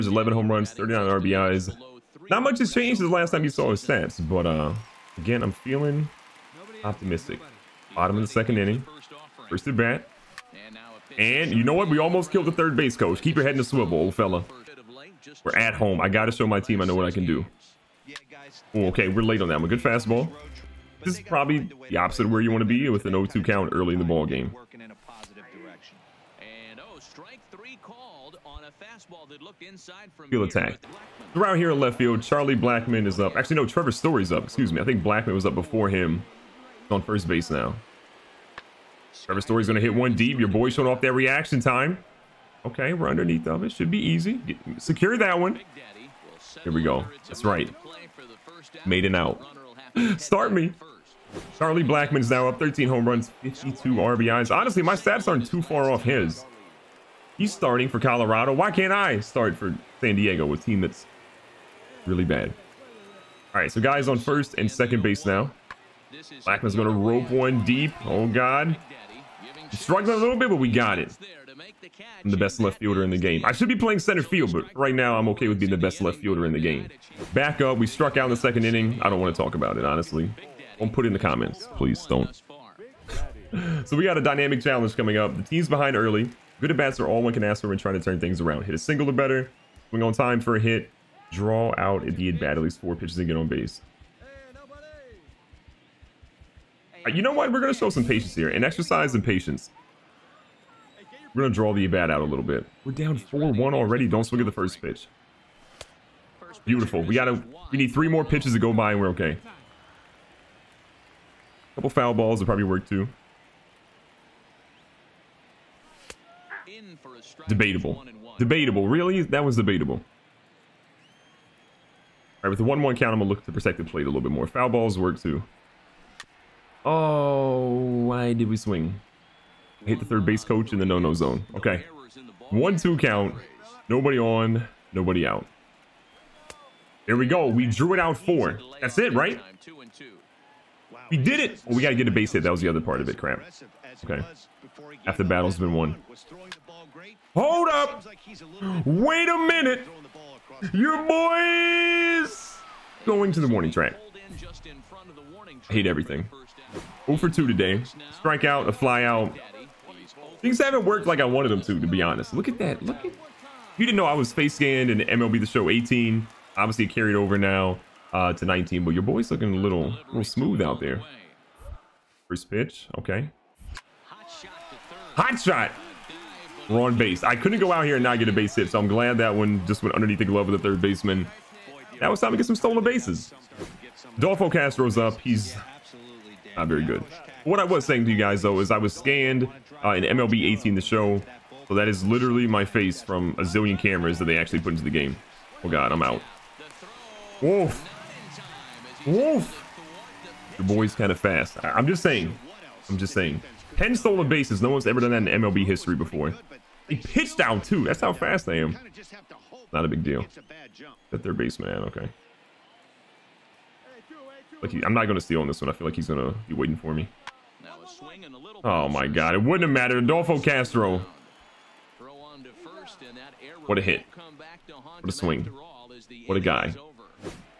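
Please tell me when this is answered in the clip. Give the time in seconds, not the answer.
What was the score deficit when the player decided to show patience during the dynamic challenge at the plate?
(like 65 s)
103 s.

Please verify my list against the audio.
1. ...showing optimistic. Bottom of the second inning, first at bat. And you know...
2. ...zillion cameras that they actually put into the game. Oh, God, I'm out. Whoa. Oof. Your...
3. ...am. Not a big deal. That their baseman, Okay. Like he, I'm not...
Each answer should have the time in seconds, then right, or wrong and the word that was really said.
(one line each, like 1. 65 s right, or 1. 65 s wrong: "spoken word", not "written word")
1. 5 s wrong: "feeling", not "showing"
2. 193 s right
3. 208 s right.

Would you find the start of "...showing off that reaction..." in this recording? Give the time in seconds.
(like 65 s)
40 s.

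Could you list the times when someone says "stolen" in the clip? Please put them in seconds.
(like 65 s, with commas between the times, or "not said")
182 s, 203 s.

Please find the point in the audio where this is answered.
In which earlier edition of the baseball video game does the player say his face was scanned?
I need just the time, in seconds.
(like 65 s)
164 s.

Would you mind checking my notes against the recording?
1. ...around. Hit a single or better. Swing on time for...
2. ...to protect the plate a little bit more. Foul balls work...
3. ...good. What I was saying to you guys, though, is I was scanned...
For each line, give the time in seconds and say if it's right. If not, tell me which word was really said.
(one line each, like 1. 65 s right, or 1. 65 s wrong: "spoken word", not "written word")
1. 88 s right
2. 123 s right
3. 186 s right.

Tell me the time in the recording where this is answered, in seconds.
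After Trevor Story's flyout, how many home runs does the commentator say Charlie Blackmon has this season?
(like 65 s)
52 s.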